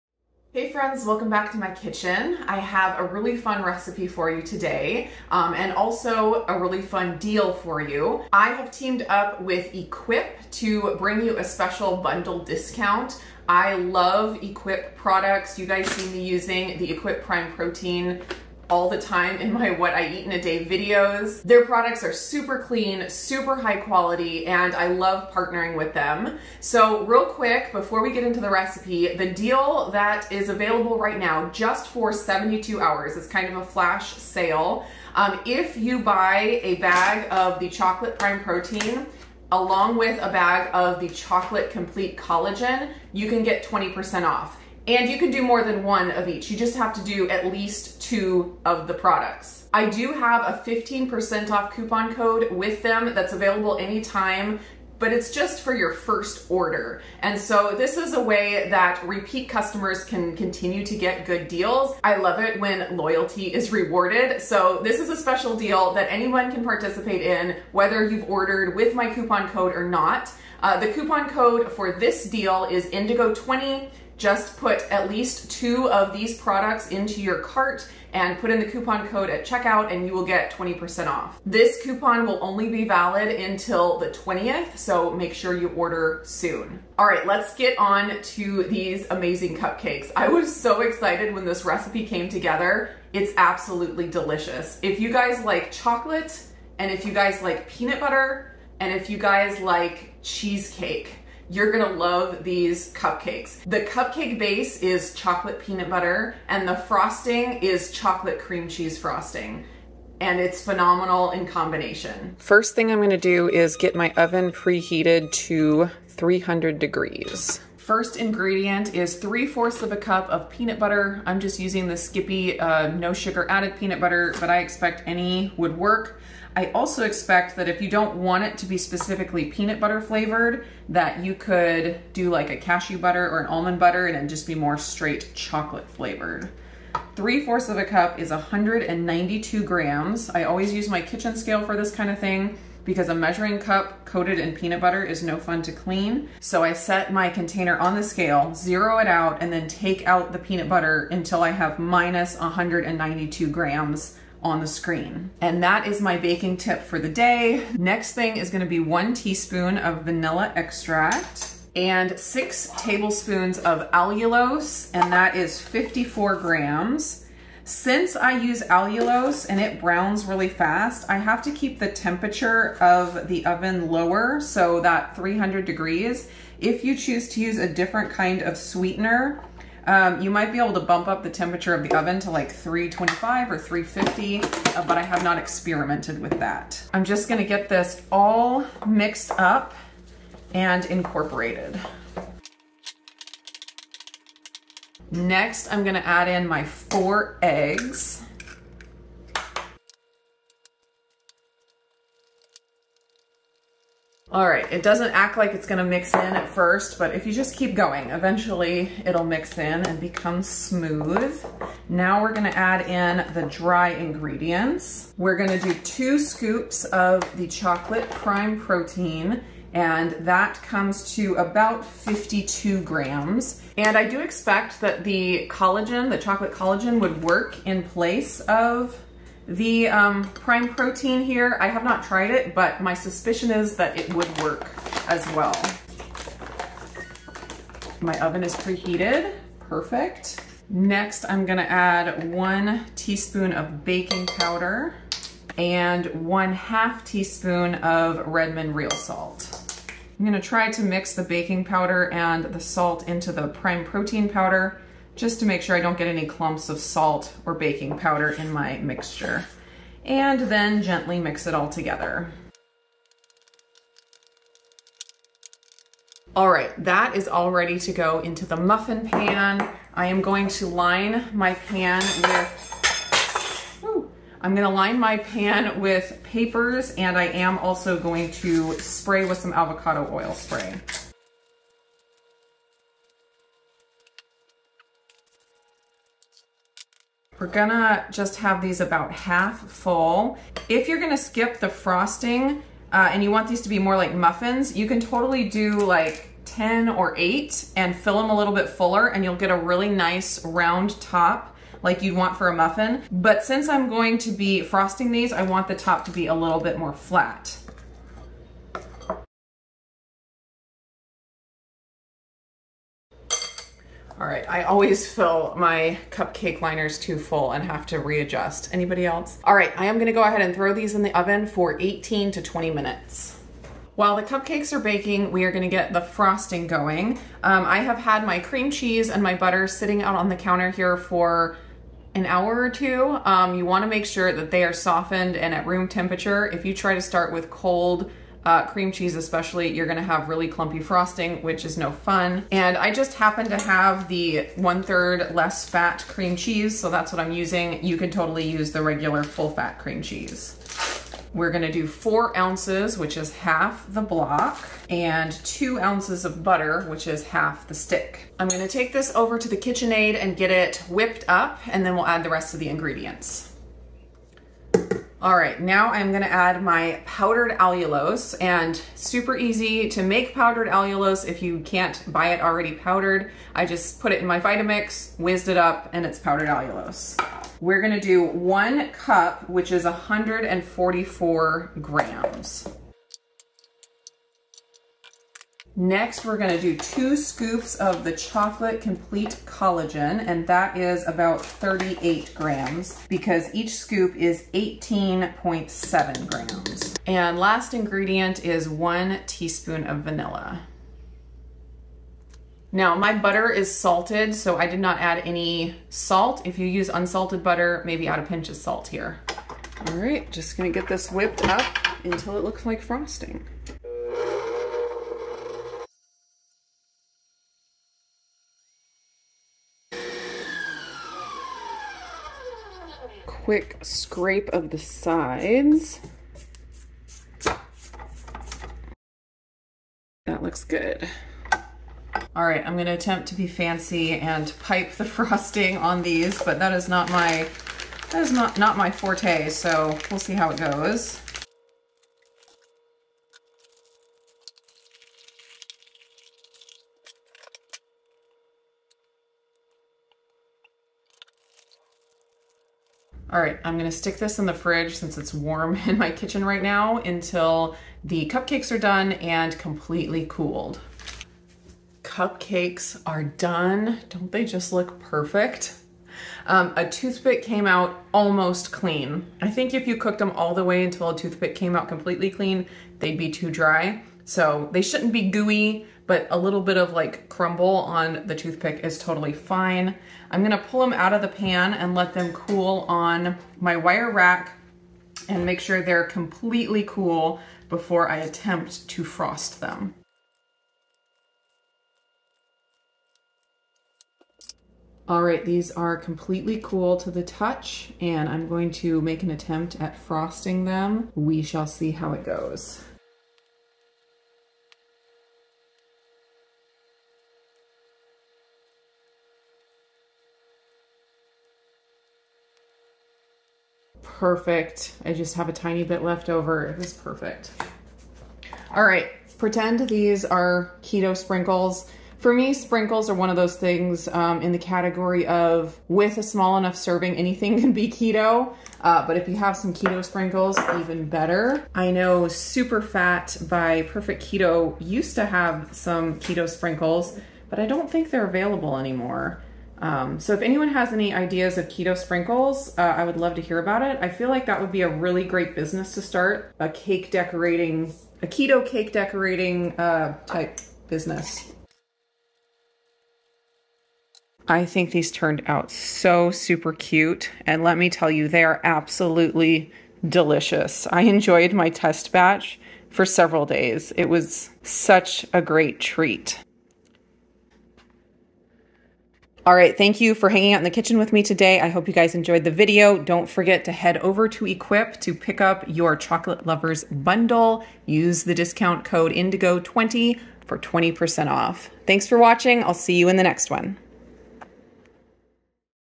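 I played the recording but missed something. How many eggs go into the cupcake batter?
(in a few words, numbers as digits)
4.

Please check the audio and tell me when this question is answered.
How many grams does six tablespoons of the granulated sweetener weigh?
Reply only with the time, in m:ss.
2:45.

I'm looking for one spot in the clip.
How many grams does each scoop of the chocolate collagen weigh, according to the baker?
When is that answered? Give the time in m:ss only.
6:34.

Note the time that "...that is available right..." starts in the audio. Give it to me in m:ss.
0:29.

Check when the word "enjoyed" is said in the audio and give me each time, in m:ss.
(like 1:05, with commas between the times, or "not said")
9:21, 9:32.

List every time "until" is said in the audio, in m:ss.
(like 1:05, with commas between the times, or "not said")
1:23, 2:31, 6:52, 7:36, 7:50.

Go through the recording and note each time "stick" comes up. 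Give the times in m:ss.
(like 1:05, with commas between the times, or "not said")
5:57, 7:33.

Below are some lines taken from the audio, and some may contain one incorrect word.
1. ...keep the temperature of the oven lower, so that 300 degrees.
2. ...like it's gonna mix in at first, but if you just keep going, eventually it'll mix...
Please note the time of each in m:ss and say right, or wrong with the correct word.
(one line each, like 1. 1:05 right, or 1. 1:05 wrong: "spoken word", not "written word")
1. 2:51 right
2. 3:25 right.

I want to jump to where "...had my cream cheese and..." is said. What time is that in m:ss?
5:27.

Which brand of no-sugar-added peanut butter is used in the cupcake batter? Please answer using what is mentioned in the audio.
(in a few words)
Skippy.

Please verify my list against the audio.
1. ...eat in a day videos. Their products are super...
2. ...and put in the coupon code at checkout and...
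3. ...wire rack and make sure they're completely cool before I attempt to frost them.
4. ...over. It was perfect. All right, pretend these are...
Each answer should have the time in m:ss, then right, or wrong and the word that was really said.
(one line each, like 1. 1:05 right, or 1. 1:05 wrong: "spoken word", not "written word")
1. 0:20 right
2. 1:18 right
3. 8:03 right
4. 8:36 right.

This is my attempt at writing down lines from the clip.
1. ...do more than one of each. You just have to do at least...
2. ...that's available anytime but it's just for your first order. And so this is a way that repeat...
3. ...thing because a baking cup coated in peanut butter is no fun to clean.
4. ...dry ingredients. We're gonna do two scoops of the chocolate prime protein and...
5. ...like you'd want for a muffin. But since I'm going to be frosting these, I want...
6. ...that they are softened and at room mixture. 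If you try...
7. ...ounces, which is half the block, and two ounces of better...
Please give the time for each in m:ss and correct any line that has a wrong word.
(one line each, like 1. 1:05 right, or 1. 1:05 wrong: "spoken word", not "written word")
1. 0:45 right
2. 0:53 right
3. 2:22 wrong: "measuring", not "baking"
4. 3:33 right
5. 5:01 right
6. 5:34 wrong: "temperature", not "mixture"
7. 5:52 wrong: "butter", not "better".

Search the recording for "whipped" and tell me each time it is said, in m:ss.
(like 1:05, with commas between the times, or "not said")
6:00, 6:51.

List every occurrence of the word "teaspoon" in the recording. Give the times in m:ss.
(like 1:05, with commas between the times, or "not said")
2:39, 4:02, 4:07, 6:39.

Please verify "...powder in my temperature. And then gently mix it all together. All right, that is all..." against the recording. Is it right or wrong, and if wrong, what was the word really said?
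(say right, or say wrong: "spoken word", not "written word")
wrong: "mixture", not "temperature".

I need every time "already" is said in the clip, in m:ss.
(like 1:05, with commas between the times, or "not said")
6:12.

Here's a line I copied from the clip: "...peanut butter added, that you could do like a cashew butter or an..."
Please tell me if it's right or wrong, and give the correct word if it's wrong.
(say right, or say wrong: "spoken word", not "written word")
wrong: "flavored", not "added".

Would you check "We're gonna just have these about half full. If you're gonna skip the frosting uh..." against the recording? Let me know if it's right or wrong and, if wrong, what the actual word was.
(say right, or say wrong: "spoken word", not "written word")
right.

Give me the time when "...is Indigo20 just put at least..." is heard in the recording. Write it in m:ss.
1:12.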